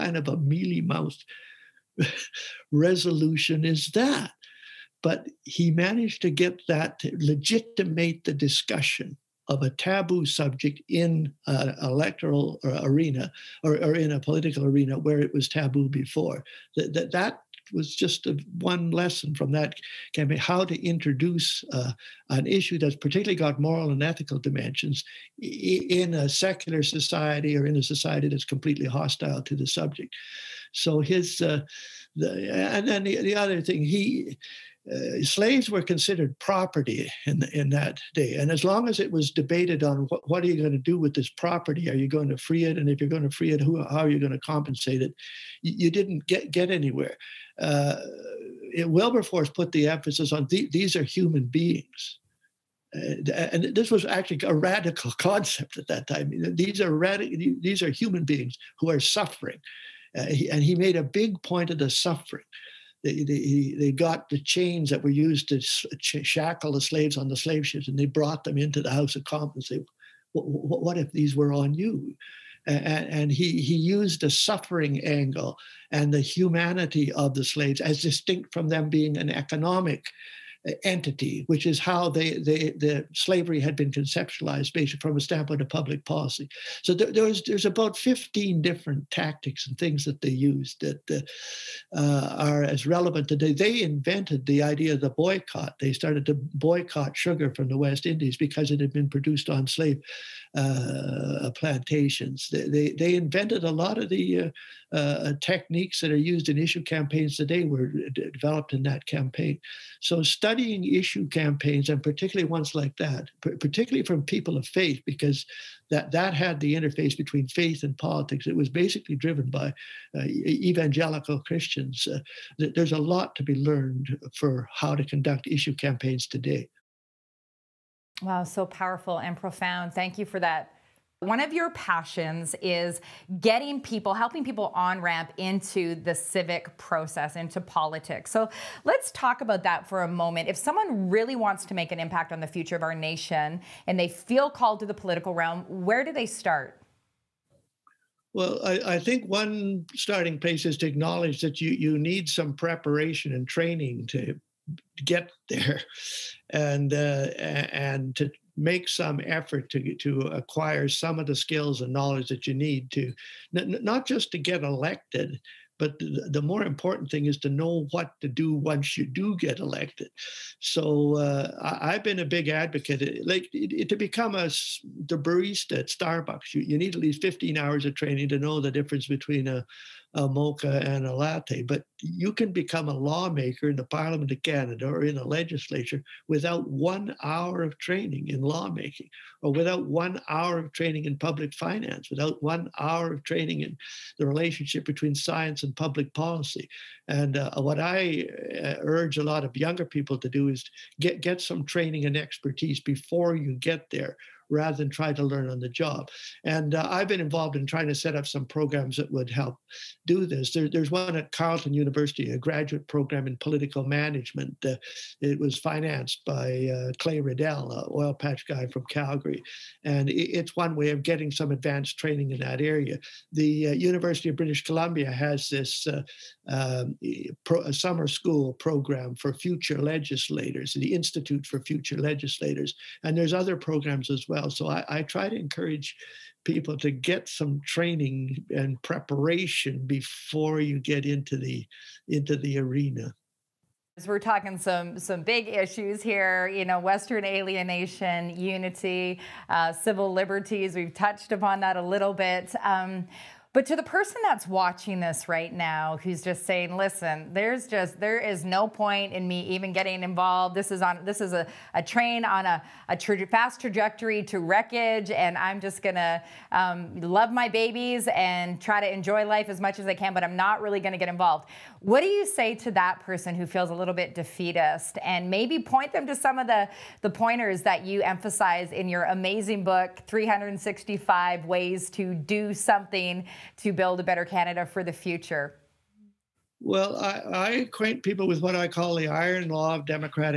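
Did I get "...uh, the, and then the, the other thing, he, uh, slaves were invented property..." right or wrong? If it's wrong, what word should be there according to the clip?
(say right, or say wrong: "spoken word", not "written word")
wrong: "considered", not "invented".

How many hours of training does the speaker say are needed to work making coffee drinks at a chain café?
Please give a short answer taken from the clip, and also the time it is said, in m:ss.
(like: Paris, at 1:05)
15, at 2:57.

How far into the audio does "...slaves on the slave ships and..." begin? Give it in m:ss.
1:06.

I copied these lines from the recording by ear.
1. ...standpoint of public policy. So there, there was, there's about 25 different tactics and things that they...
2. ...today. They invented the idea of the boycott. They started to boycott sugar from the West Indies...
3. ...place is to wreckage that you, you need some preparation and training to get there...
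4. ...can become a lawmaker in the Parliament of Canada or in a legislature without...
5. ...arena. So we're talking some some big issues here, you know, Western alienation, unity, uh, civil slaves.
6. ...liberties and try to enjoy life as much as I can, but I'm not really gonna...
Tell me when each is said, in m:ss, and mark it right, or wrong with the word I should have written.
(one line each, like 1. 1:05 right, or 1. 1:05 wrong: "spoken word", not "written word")
1. 1:25 wrong: "15", not "25"
2. 1:33 right
3. 2:30 wrong: "acknowledge", not "wreckage"
4. 3:02 right
5. 4:02 wrong: "liberties", not "slaves"
6. 4:27 wrong: "babies", not "liberties".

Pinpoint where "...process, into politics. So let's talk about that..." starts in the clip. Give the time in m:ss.
2:16.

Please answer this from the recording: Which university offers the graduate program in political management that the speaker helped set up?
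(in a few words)
Carleton University.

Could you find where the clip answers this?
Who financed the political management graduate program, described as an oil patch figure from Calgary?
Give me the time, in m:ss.
3:36.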